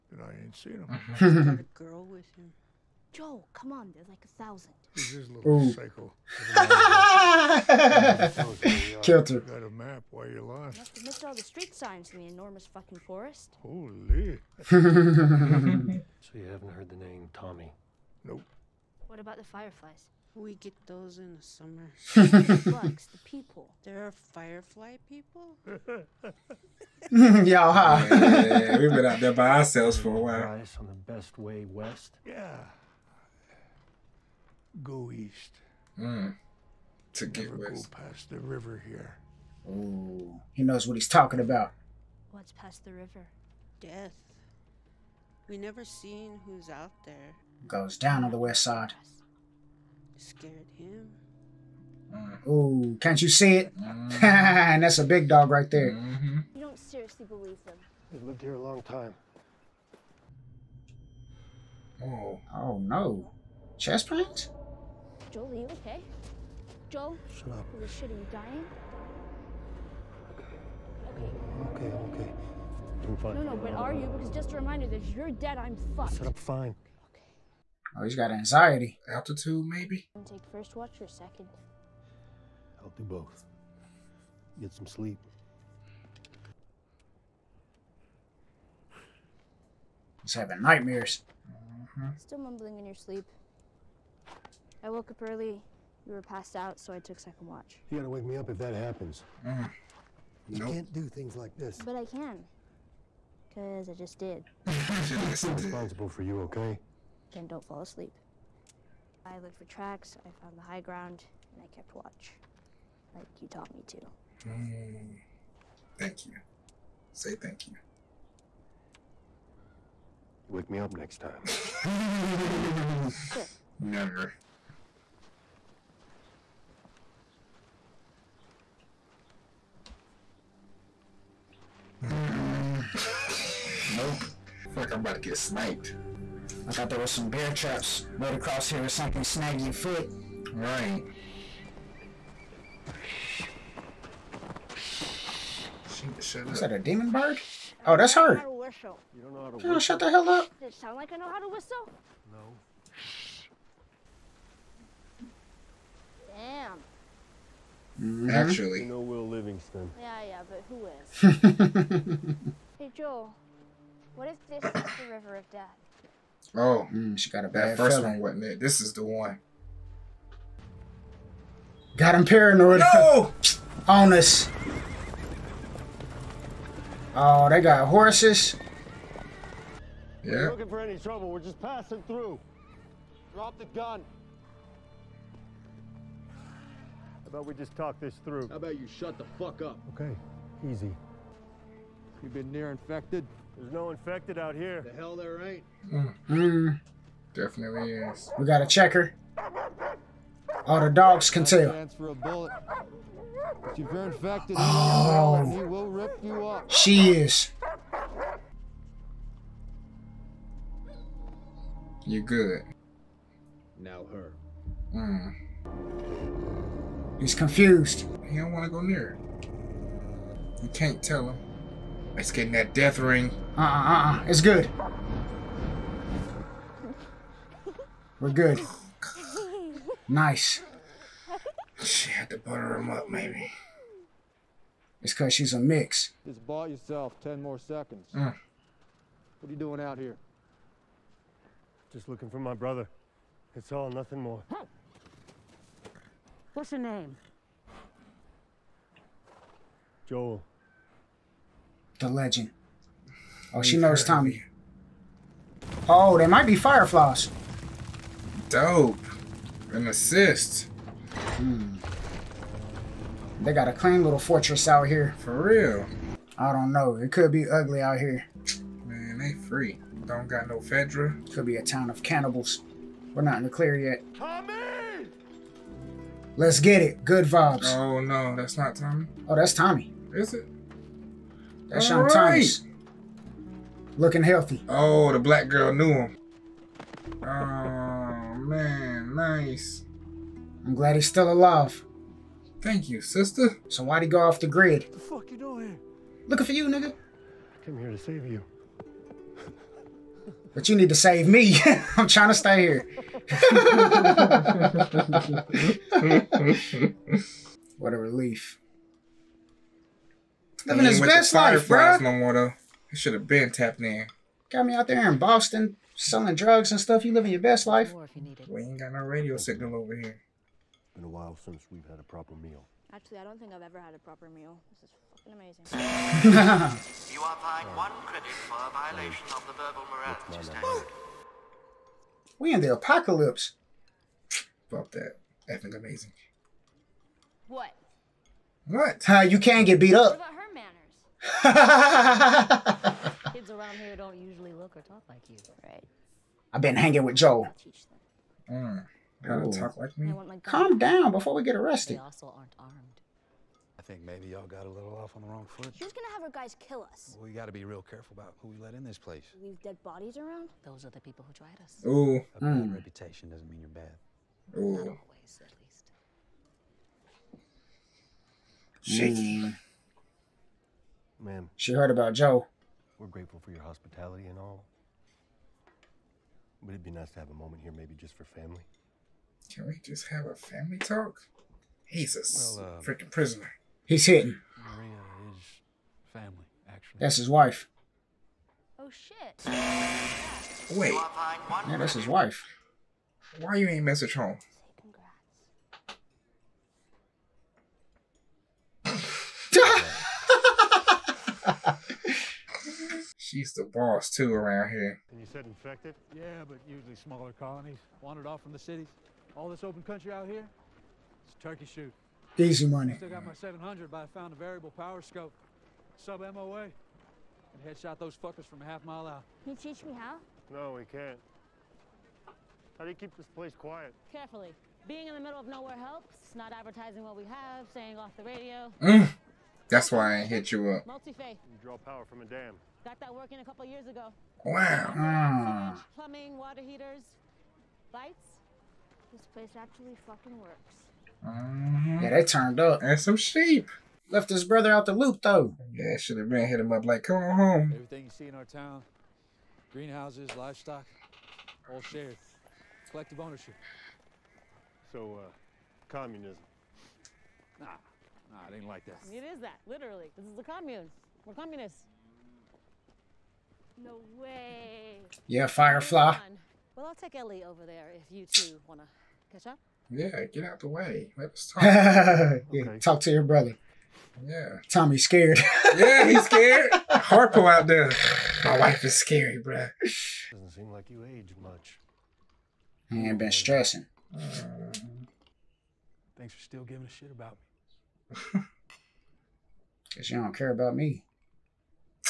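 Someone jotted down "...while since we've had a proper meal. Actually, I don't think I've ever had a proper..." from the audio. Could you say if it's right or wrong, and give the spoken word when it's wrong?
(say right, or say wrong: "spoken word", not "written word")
right.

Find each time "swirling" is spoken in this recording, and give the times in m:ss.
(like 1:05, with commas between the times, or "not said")
not said.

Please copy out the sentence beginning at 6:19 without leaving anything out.
Can we just have a family talk?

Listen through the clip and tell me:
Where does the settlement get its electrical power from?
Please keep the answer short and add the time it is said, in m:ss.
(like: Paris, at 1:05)
A dam, at 7:12.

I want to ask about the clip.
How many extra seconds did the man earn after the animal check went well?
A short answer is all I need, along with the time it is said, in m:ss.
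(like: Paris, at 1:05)
10, at 3:57.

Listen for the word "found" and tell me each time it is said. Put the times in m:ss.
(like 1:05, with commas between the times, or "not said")
1:50, 6:54.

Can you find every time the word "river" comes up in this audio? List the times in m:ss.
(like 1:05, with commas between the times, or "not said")
0:38, 0:42, 2:45.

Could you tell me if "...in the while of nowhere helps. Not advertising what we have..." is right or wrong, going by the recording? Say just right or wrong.
wrong.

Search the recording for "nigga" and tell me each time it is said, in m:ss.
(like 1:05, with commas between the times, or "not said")
4:56.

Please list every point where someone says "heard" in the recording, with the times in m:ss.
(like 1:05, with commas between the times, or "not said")
0:16, 6:11.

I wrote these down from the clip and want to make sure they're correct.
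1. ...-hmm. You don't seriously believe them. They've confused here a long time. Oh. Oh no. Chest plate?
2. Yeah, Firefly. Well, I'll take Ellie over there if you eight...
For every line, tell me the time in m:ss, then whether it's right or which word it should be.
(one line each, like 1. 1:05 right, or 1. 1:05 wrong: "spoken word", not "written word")
1. 0:56 wrong: "lived", not "confused"
2. 7:45 wrong: "two", not "eight".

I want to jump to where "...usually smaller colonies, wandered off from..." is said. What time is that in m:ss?
6:46.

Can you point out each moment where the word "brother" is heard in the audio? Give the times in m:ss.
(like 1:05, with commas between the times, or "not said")
4:02, 7:24, 7:53.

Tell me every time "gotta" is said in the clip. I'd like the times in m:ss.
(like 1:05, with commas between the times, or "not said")
1:37, 5:49, 5:57.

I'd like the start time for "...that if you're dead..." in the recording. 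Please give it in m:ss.
1:14.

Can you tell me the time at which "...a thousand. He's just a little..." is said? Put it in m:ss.
0:04.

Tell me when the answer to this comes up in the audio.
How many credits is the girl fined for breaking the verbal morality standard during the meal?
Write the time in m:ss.
5:27.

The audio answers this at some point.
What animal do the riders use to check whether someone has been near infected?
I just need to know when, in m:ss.
3:20.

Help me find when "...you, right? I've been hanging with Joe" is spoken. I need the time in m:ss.
5:45.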